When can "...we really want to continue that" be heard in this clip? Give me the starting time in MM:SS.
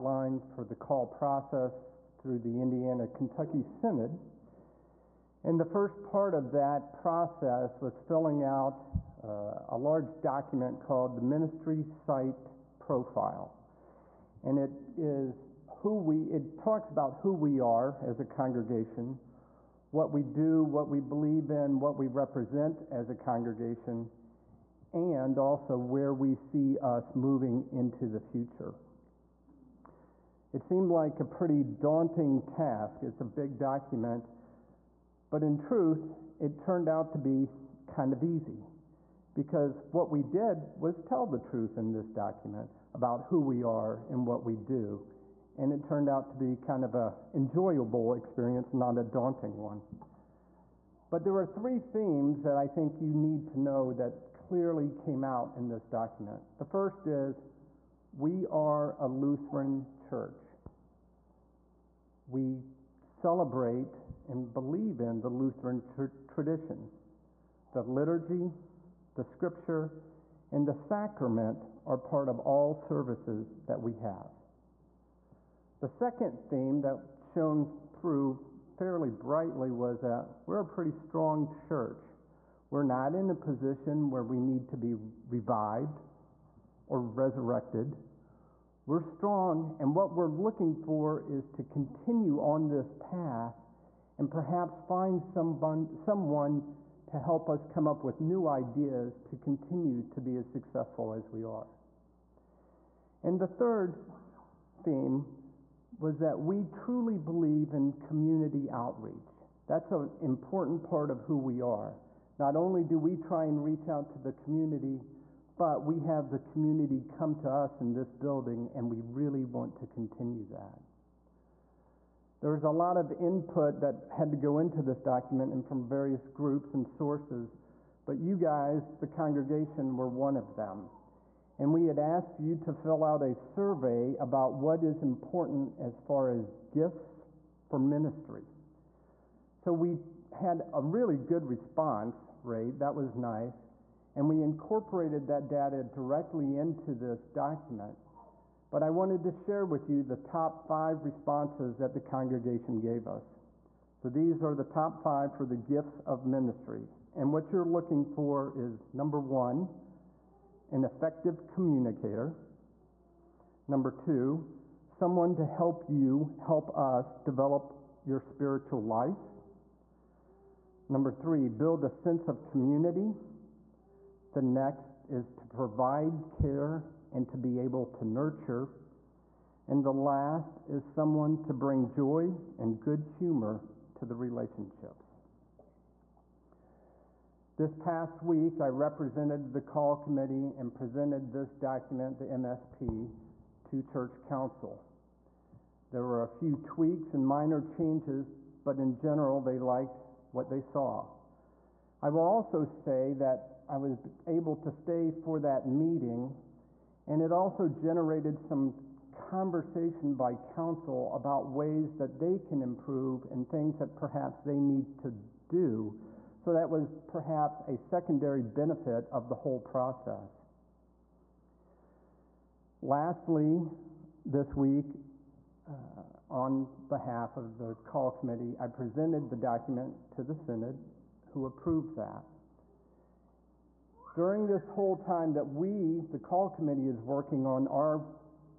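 01:58.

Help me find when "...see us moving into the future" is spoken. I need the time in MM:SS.
00:26.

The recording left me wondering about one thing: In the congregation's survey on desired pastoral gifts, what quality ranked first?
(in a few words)
An effective communicator.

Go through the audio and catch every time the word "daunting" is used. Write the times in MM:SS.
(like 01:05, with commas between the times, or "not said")
00:31, 00:49.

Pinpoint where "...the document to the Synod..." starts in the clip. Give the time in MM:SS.
03:49.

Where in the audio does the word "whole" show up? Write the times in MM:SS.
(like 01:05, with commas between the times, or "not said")
03:39, 03:54.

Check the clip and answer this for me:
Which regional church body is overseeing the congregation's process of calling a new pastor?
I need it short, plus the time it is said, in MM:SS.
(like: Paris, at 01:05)
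Indiana Kentucky Synod, at 00:02.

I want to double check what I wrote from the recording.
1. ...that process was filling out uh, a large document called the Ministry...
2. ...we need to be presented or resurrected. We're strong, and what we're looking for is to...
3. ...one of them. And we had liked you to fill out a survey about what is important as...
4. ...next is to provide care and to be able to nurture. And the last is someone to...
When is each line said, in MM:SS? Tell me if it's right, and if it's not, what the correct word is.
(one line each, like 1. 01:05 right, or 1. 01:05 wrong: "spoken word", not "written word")
1. 00:06 right
2. 01:24 wrong: "revived", not "presented"
3. 02:10 wrong: "asked", not "liked"
4. 02:54 right.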